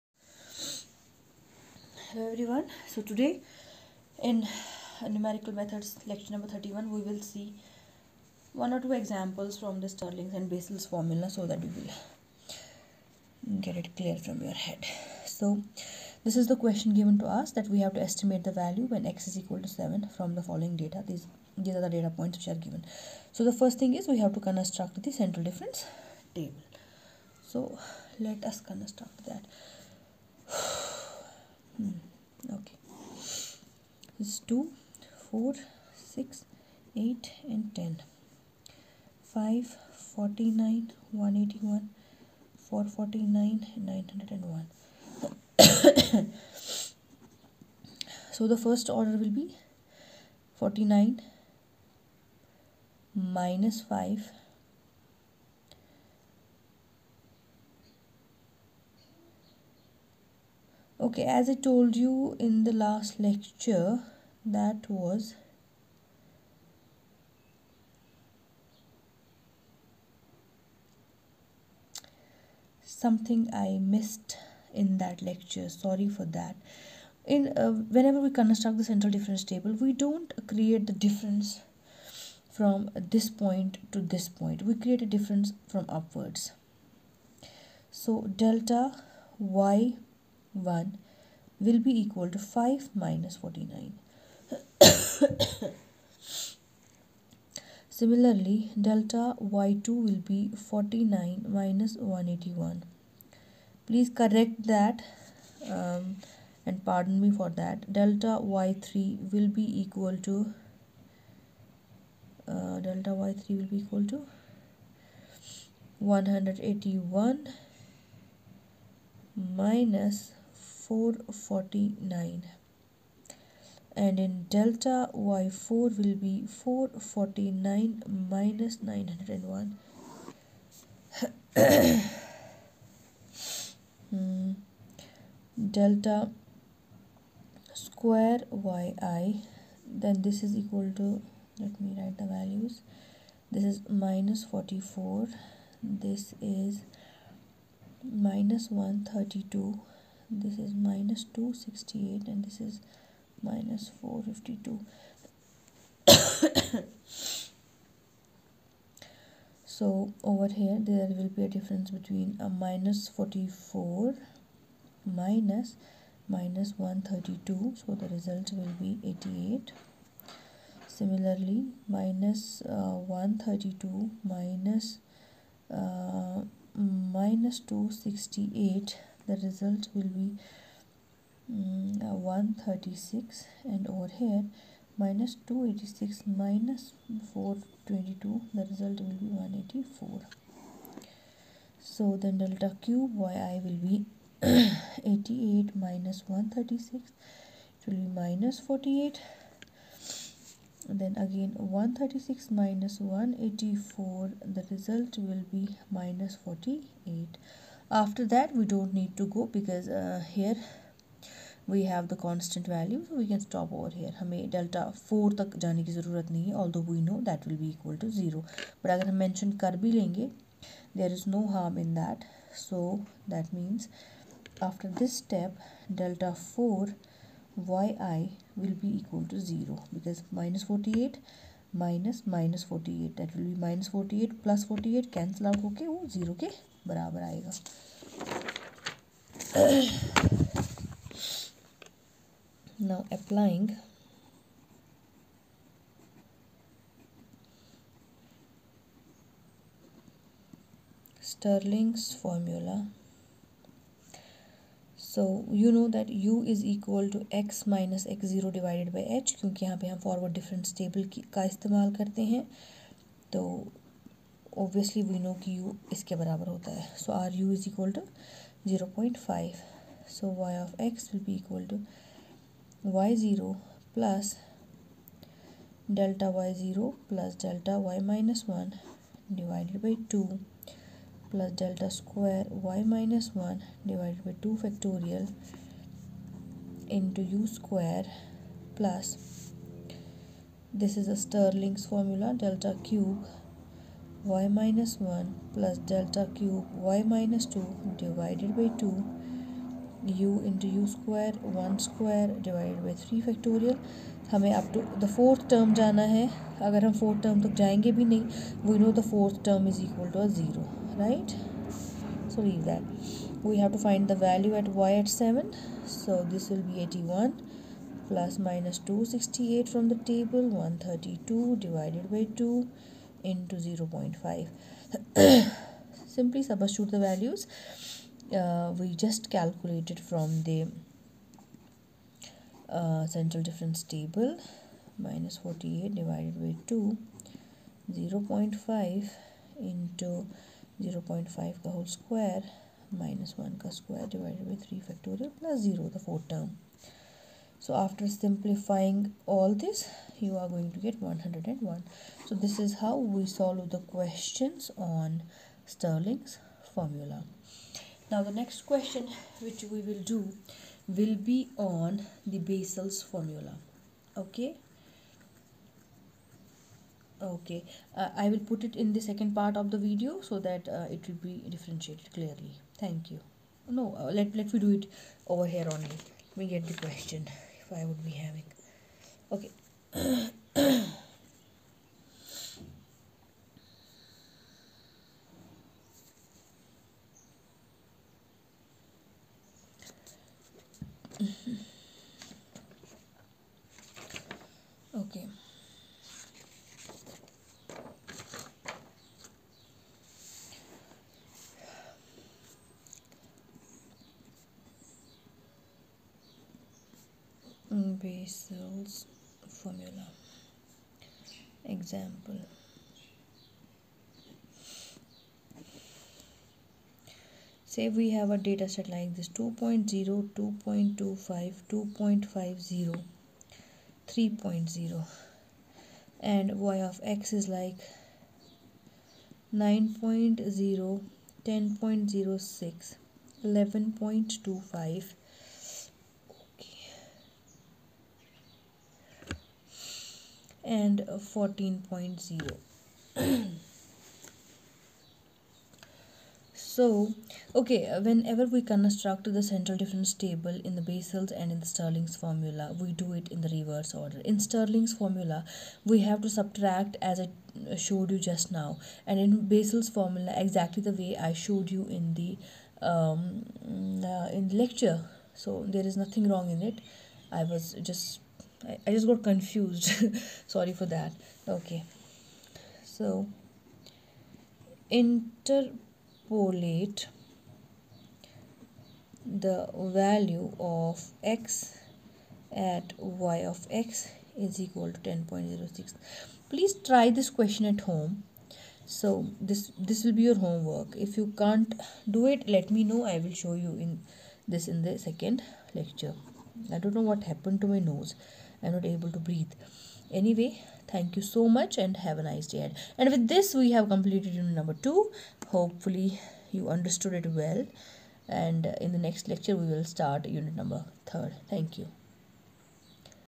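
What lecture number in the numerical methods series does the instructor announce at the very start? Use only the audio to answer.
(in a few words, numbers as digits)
31.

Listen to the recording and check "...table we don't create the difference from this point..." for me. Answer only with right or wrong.
right.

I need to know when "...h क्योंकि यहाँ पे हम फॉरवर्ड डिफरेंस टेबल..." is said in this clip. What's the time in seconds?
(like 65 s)
259 s.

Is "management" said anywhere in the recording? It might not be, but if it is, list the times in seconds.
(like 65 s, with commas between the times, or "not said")
not said.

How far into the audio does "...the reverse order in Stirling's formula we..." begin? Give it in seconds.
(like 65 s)
453 s.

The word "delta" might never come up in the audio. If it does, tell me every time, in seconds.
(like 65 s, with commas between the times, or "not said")
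88 s, 98 s, 107 s, 112 s, 124 s, 135 s, 192 s, 295 s.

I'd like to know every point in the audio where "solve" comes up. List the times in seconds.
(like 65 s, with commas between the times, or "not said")
353 s.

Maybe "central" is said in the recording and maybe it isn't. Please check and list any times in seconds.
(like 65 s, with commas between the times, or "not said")
25 s, 78 s, 333 s, 449 s.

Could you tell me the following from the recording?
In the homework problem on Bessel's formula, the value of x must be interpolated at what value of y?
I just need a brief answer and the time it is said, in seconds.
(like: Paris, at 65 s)
10.06, at 484 s.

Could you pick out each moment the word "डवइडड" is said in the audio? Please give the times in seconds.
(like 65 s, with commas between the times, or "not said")
279 s, 283 s, 321 s, 344 s.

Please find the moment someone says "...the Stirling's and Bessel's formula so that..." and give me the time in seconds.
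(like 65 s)
9 s.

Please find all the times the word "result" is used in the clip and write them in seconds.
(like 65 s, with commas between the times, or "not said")
168 s, 179 s, 188 s, 204 s.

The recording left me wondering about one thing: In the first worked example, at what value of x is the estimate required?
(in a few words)
7.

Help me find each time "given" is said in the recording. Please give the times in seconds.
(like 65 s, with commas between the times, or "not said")
16 s, 22 s.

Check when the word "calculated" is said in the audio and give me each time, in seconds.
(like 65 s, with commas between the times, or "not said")
329 s.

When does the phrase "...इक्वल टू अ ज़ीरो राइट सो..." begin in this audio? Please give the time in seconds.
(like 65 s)
309 s.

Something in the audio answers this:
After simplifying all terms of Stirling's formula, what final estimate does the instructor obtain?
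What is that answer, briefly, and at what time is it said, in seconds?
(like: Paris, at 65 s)
101, at 350 s.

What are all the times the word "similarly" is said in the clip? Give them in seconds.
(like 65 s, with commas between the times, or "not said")
97 s, 170 s.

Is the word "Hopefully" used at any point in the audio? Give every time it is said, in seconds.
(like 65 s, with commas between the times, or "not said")
505 s.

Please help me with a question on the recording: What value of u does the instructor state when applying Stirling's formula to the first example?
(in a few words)
0.5.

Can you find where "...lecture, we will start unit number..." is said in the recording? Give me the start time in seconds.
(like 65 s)
509 s.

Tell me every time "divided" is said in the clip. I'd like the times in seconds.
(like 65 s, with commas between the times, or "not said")
258 s, 298 s, 302 s, 335 s.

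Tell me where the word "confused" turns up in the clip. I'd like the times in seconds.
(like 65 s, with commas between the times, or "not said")
469 s.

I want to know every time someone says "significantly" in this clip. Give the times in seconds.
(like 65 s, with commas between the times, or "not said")
not said.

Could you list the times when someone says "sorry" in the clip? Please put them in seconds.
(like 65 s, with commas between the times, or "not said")
75 s, 470 s.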